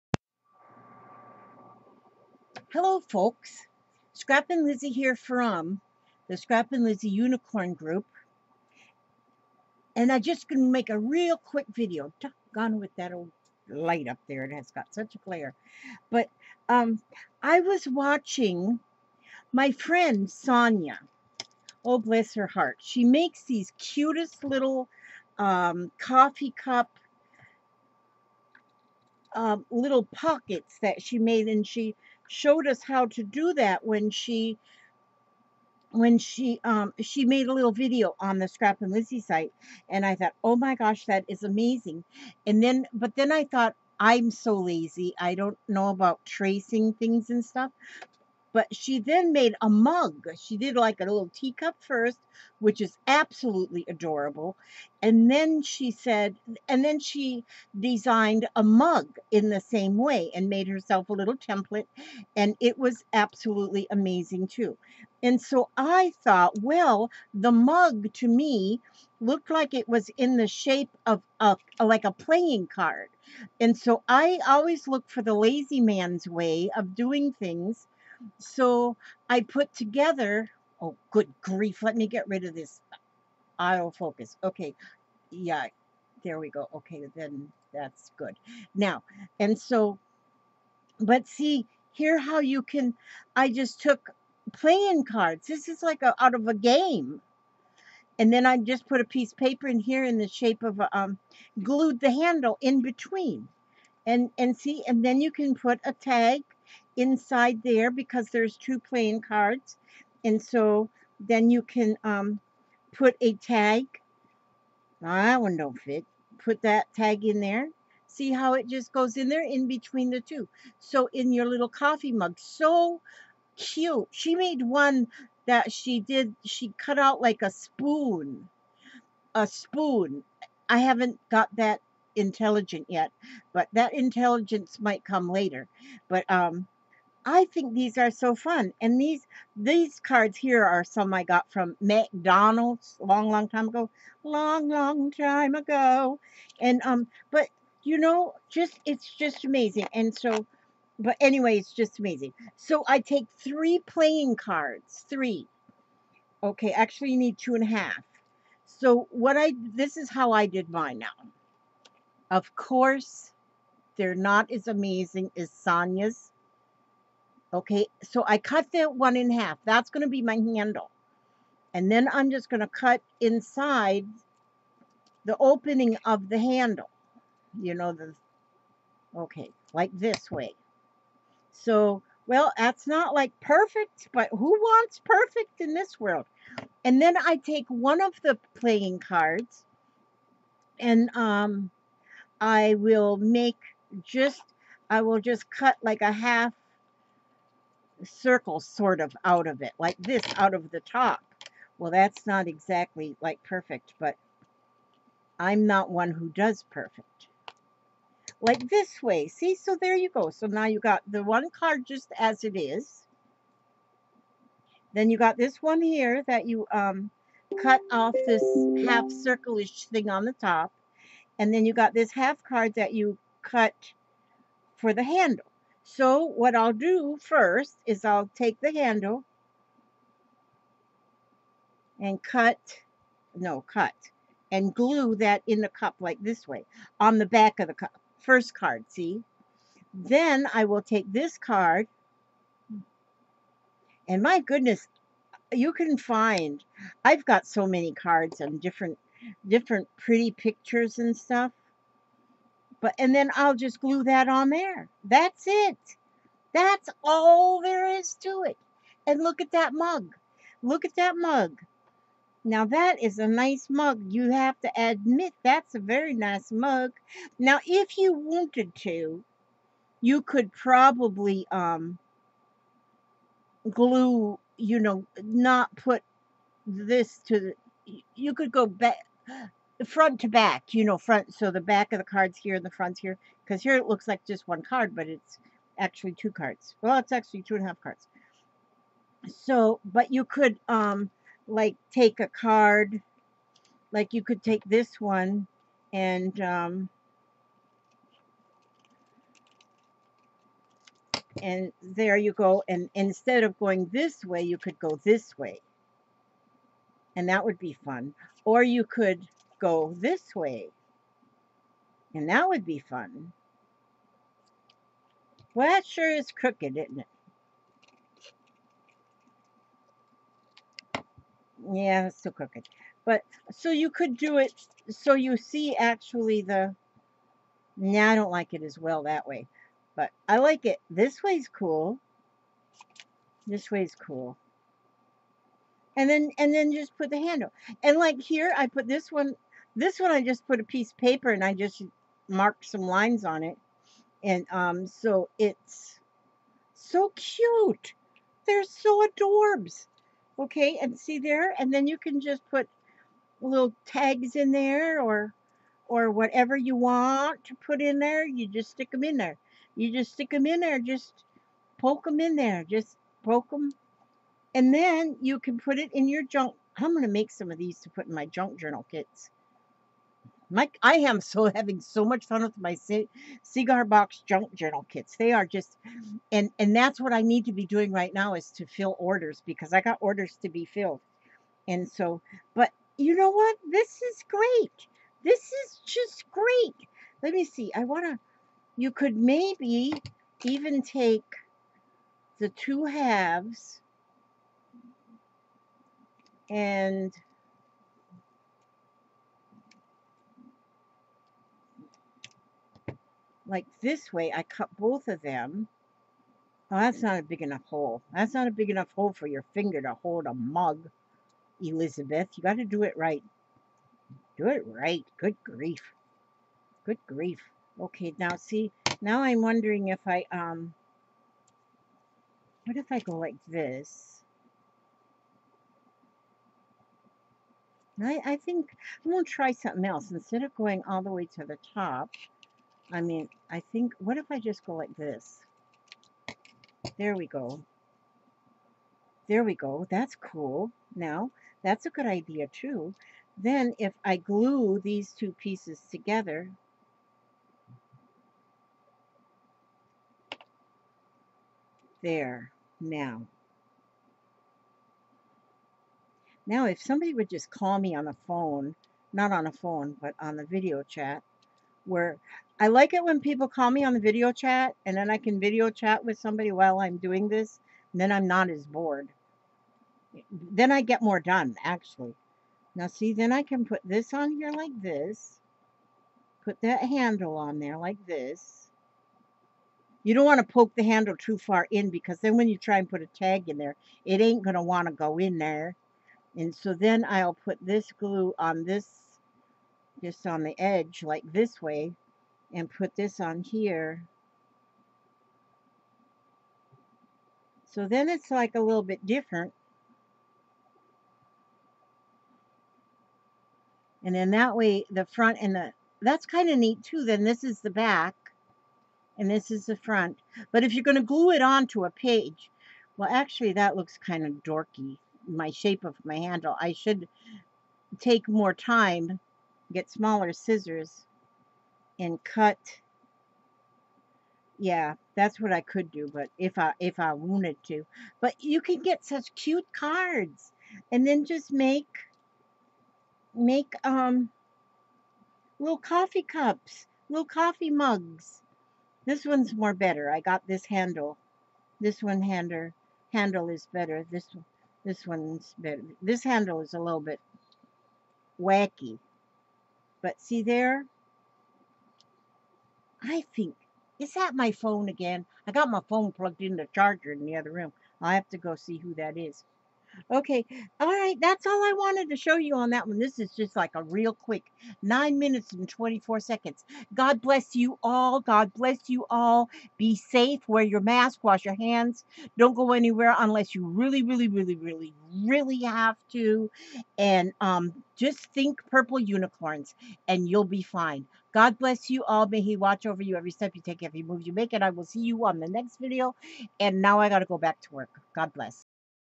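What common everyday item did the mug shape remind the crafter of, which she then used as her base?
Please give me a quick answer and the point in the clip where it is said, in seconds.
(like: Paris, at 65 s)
playing card, at 72 s.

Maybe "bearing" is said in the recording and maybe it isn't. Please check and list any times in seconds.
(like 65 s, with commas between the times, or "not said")
not said.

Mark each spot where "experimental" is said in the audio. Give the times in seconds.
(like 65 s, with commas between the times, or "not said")
not said.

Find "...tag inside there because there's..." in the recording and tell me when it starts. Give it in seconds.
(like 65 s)
105 s.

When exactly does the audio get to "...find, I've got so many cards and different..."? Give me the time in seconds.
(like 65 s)
245 s.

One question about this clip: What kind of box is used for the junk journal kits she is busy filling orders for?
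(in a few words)
cigar box.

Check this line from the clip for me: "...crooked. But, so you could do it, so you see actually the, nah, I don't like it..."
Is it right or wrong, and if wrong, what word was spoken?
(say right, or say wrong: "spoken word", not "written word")
right.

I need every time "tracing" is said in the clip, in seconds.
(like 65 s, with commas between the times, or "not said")
46 s.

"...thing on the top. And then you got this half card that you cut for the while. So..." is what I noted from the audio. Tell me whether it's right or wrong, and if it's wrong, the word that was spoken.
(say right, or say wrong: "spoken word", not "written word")
wrong: "handle", not "while".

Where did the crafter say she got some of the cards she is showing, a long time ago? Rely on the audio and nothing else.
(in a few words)
McDonald's.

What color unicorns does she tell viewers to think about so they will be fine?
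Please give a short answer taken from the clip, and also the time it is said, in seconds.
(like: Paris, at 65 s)
purple, at 578 s.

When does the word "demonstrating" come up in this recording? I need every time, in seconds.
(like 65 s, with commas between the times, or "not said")
not said.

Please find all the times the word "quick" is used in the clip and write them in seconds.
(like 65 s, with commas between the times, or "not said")
11 s, 564 s.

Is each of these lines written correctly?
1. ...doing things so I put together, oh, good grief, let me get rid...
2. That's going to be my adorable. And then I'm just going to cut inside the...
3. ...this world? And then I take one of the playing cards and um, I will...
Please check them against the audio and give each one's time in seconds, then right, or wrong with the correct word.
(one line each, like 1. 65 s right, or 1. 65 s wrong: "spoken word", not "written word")
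1. 76 s right
2. 169 s wrong: "handle", not "adorable"
3. 185 s right.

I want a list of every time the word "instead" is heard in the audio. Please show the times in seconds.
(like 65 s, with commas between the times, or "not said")
302 s, 430 s.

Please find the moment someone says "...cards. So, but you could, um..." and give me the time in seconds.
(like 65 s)
287 s.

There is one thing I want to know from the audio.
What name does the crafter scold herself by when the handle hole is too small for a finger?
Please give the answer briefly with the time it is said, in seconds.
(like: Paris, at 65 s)
Elizabeth, at 411 s.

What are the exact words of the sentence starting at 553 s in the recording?
I think, is that my phone again?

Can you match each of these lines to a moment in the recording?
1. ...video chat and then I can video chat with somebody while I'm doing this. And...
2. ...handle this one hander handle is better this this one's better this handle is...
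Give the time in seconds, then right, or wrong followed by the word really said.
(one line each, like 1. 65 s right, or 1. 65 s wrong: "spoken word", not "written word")
1. 463 s right
2. 540 s right.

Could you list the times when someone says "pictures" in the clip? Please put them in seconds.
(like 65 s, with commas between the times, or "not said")
250 s.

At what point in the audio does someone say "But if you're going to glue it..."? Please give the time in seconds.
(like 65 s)
510 s.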